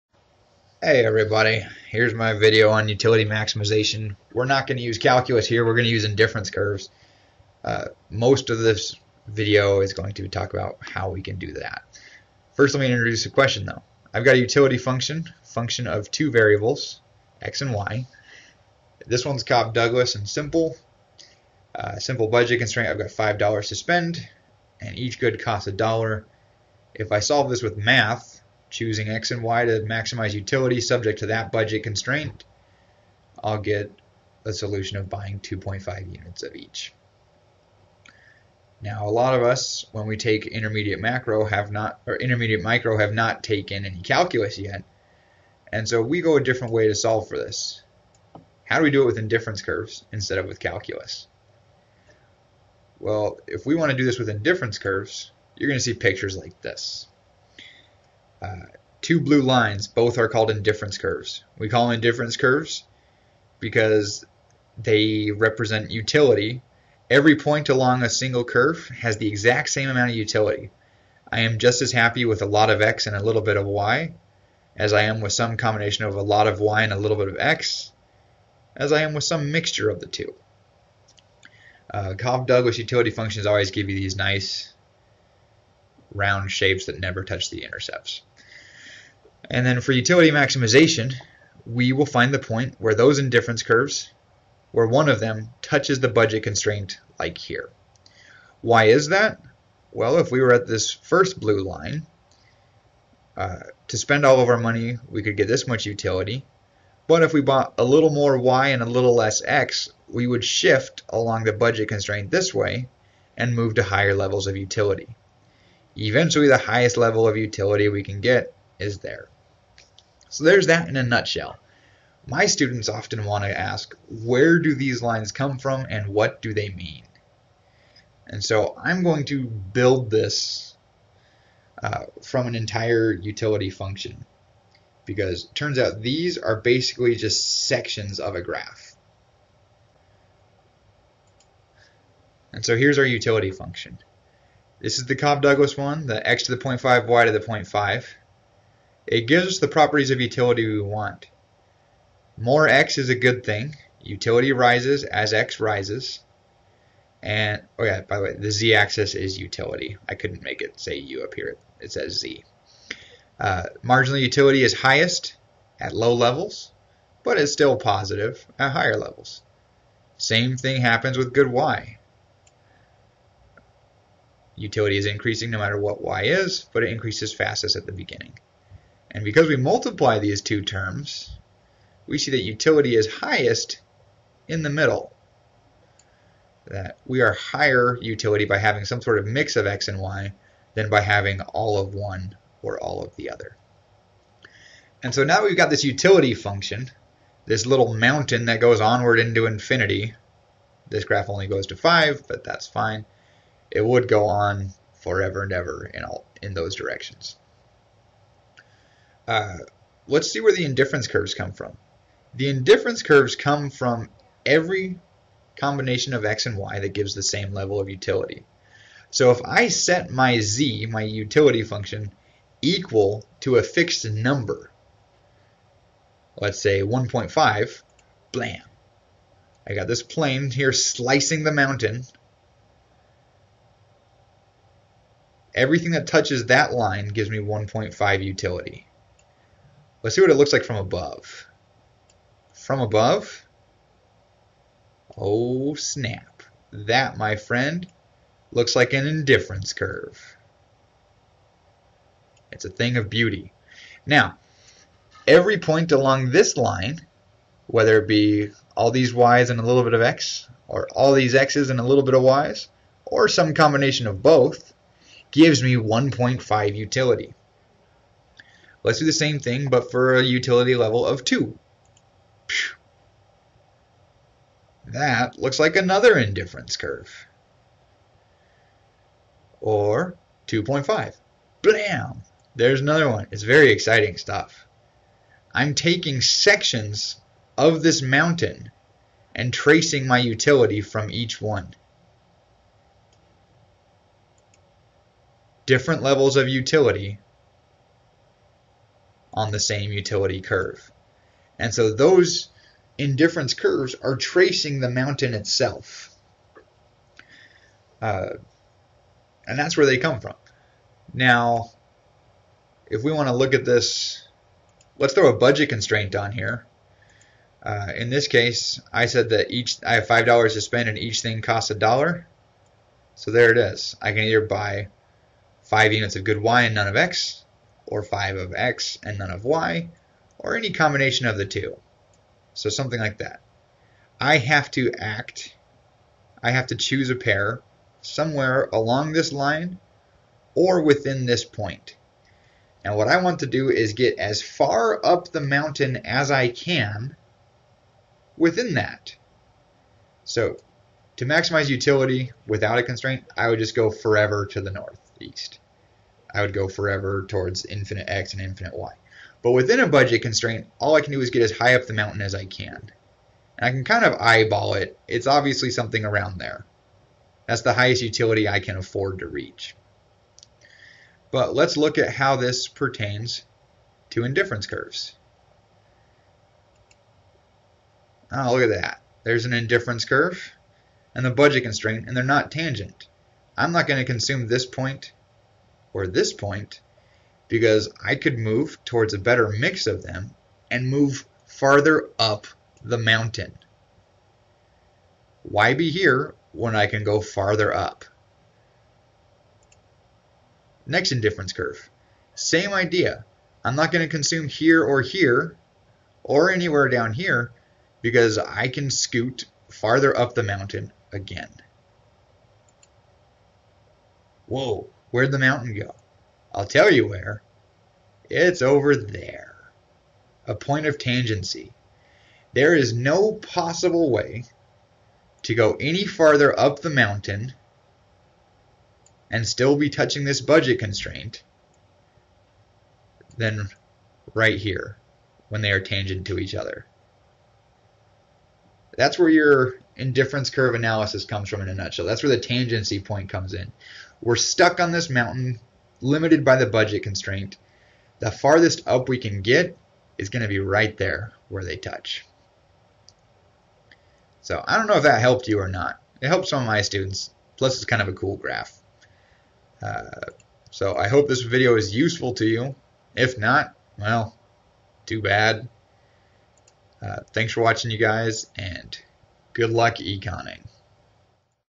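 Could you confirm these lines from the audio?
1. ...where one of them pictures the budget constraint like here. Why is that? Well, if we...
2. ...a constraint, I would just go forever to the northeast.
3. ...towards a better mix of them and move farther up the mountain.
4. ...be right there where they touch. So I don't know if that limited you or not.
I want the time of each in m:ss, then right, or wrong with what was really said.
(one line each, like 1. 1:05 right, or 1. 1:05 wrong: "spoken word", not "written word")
1. 1:34 wrong: "touches", not "pictures"
2. 5:52 right
3. 6:28 right
4. 7:30 wrong: "helped", not "limited".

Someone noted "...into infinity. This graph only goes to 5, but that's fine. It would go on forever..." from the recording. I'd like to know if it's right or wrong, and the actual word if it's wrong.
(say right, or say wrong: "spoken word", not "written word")
right.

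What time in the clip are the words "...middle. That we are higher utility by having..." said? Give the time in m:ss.
3:04.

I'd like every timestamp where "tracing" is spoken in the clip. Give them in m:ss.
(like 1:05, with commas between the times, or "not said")
4:49, 5:04.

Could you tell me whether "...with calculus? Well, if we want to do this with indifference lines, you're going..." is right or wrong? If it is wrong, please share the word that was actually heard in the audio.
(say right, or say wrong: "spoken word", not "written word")
wrong: "curves", not "lines".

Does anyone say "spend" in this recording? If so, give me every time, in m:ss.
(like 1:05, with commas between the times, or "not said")
0:23, 1:43, 5:20.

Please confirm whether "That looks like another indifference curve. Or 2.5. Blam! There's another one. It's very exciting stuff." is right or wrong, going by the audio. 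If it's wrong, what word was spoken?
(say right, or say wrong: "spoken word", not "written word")
right.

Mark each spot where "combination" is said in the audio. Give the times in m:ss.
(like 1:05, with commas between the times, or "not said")
1:15, 3:35, 4:23, 5:30.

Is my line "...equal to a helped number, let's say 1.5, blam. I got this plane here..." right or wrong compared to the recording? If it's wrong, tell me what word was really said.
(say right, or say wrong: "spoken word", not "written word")
wrong: "fixed", not "helped".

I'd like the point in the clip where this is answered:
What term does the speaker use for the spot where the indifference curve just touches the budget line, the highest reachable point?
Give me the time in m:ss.
7:00.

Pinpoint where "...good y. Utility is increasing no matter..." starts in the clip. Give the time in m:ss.
2:51.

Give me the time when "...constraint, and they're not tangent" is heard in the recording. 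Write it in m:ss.
6:21.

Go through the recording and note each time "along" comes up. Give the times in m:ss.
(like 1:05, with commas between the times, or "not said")
1:07, 1:51, 4:15, 5:38.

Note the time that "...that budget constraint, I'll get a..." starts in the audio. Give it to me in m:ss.
0:31.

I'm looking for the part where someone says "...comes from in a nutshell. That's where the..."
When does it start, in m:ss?
7:21.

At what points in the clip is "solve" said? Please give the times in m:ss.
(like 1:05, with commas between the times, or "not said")
0:27, 0:46.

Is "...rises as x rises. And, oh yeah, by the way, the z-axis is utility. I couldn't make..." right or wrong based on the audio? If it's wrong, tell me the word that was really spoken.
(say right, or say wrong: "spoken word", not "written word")
right.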